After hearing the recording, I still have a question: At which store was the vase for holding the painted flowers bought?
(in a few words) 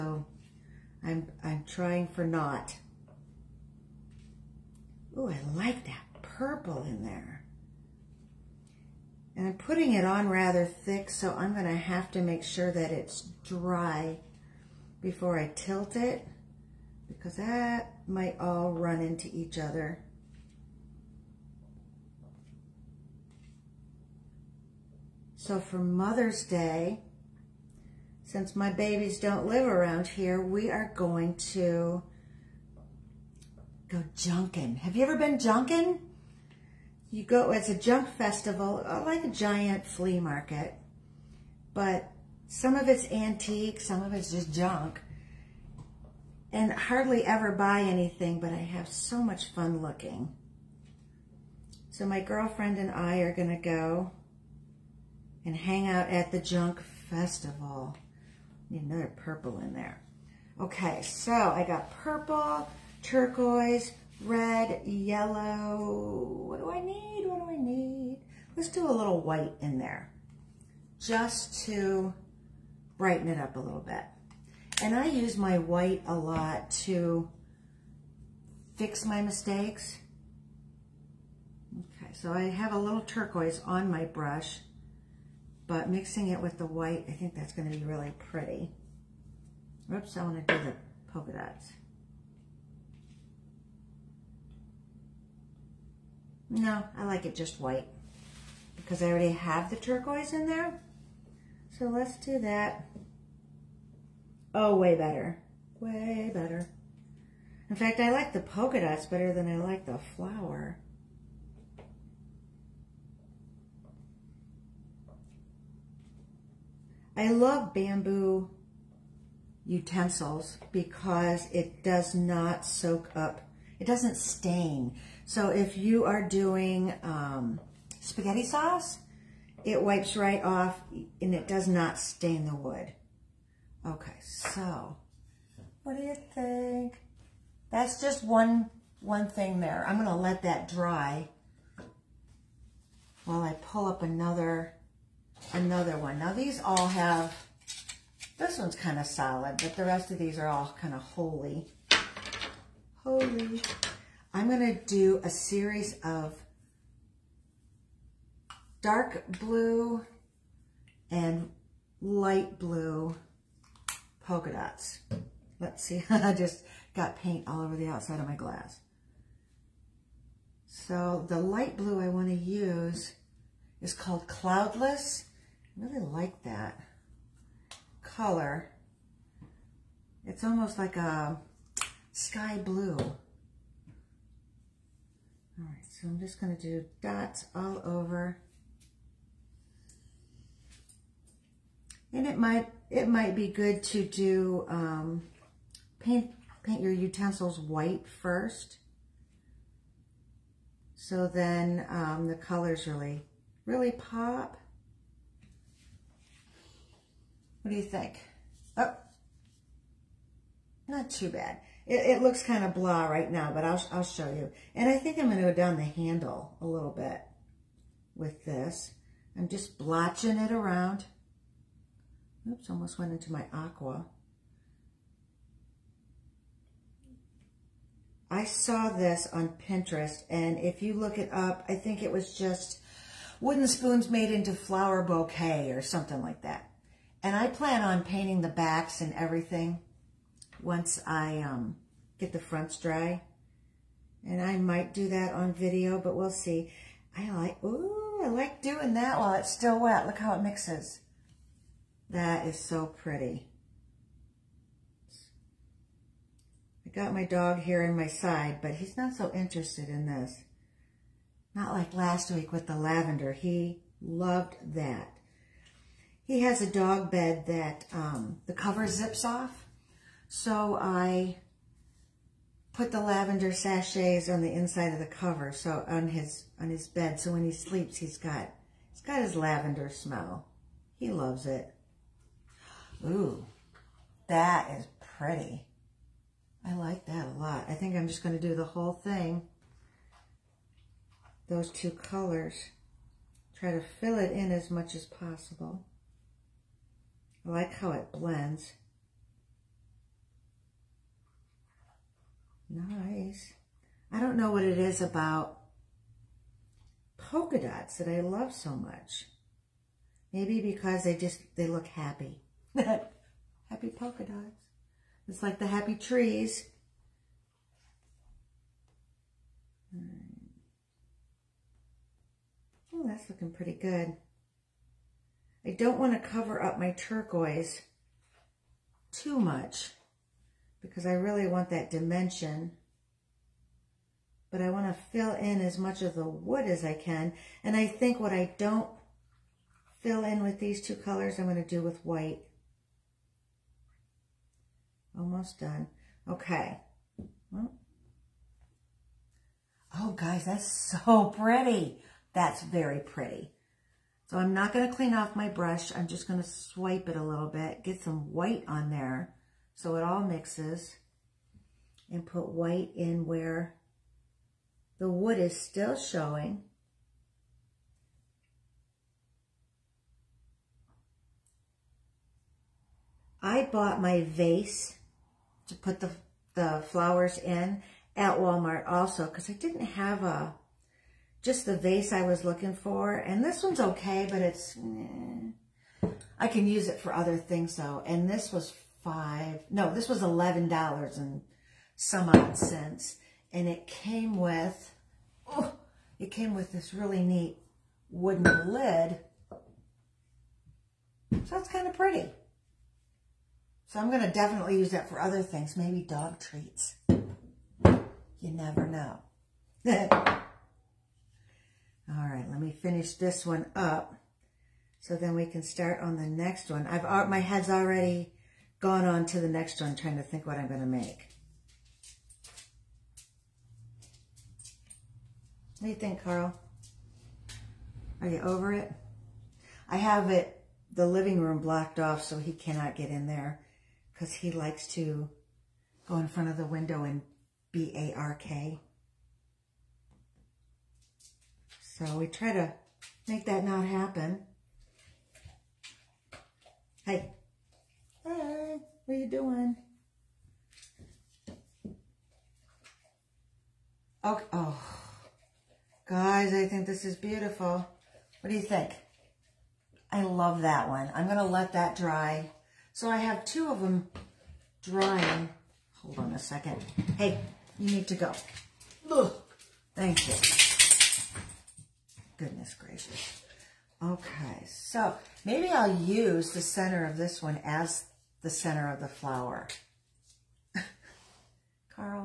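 Walmart.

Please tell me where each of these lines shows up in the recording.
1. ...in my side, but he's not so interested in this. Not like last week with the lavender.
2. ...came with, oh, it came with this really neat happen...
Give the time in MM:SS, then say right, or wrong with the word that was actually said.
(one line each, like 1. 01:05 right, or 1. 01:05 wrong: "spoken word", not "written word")
1. 04:17 right
2. 06:33 wrong: "wooden", not "happen".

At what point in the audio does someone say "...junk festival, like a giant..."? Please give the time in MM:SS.
00:37.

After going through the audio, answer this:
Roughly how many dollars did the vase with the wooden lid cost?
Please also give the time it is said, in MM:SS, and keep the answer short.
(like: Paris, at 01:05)
$11, at 06:30.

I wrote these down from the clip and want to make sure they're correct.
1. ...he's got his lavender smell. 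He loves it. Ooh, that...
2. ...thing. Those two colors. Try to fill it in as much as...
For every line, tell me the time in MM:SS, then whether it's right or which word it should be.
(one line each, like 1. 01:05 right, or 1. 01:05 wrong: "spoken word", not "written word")
1. 04:38 right
2. 04:48 right.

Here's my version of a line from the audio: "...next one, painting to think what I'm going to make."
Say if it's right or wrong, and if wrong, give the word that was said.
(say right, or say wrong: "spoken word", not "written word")
wrong: "trying", not "painting".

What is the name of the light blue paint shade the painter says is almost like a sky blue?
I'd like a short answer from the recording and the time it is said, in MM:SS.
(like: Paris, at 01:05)
Cloudless, at 02:54.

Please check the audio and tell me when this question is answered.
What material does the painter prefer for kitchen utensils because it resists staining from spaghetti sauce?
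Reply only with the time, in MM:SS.
01:57.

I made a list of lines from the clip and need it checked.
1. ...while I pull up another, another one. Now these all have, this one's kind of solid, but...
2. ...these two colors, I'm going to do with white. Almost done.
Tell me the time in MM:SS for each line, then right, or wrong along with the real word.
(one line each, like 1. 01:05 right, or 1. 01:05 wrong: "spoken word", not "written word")
1. 02:23 right
2. 05:40 right.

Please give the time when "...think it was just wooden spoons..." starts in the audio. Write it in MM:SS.
03:51.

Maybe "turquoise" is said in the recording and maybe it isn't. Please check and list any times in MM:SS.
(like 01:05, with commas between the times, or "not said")
01:03, 01:23, 01:39, 05:26.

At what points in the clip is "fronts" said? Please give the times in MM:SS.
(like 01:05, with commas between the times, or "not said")
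04:02, 07:16.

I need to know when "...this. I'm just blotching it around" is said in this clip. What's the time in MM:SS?
03:38.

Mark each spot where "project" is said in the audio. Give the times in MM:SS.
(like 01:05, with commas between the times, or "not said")
not said.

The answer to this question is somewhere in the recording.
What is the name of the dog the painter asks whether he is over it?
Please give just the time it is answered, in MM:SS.
07:06.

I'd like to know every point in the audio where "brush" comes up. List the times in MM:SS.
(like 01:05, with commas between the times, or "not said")
01:24, 05:55.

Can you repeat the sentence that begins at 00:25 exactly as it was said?
So for Mother's Day, since my babies don't live around here, we are going to go junkin'.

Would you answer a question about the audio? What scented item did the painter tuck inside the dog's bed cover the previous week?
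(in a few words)
Lavender sachets.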